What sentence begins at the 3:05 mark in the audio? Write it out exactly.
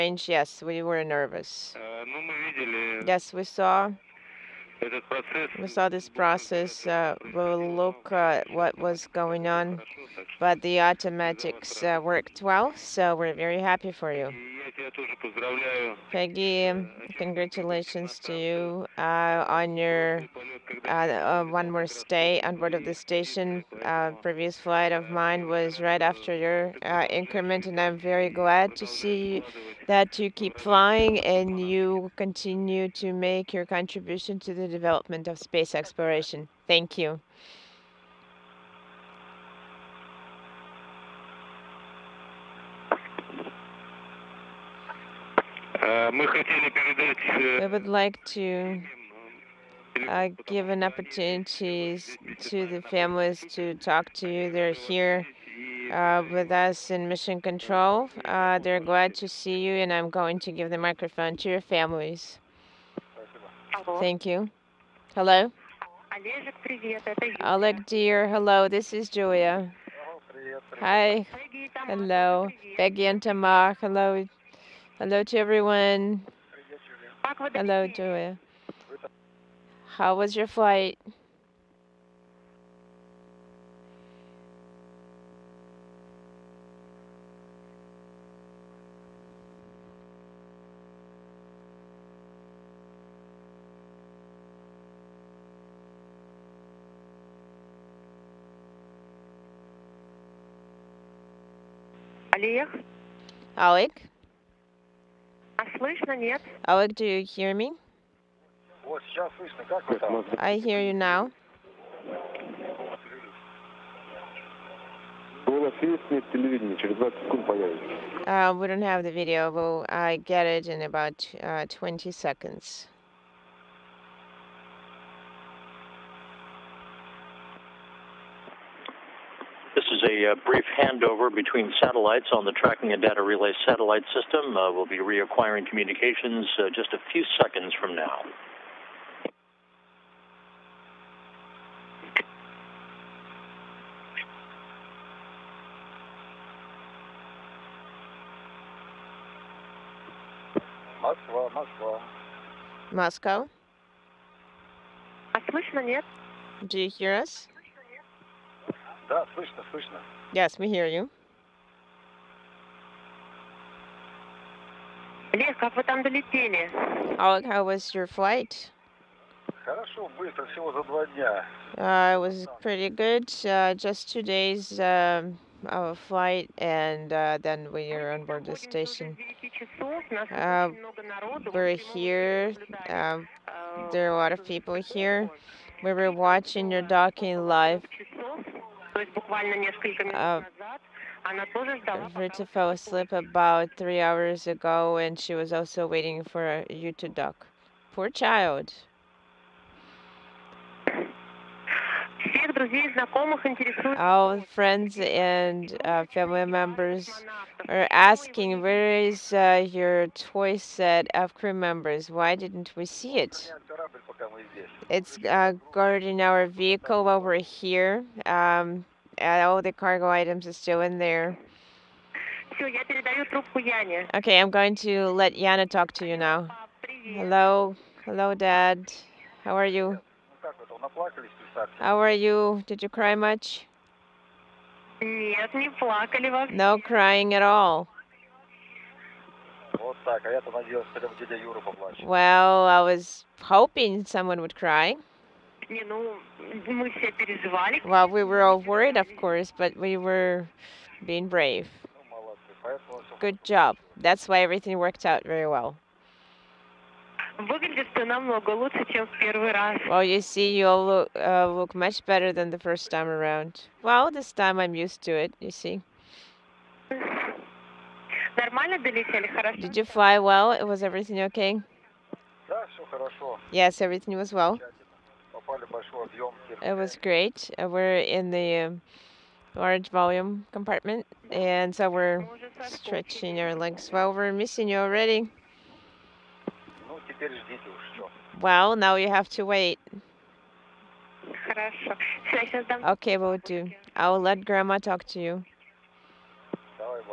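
We were watching your docking live.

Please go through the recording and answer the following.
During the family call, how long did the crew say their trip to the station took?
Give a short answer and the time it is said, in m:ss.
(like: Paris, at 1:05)
2 days, at 2:53.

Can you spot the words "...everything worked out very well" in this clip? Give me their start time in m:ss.
4:14.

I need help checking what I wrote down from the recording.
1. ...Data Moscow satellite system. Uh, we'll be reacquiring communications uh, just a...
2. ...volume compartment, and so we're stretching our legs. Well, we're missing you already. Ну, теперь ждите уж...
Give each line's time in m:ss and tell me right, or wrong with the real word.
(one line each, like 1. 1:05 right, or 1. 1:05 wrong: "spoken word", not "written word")
1. 2:13 wrong: "Relay", not "Moscow"
2. 4:39 right.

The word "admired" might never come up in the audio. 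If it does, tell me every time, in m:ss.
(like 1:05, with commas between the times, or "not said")
not said.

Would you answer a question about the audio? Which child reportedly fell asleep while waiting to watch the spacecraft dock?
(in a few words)
Rita.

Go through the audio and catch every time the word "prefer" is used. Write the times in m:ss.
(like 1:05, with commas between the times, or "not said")
not said.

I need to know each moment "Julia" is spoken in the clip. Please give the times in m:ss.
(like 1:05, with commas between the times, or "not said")
1:09, 1:17.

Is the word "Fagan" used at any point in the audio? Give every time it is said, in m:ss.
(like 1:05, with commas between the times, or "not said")
not said.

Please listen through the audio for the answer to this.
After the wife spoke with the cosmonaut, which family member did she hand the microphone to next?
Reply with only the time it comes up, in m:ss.
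3:45.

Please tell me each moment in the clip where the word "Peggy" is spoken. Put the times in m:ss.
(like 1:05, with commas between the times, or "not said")
0:16, 1:12.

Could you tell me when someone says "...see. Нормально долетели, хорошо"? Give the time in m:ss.
4:25.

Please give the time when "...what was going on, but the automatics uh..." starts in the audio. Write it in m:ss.
0:08.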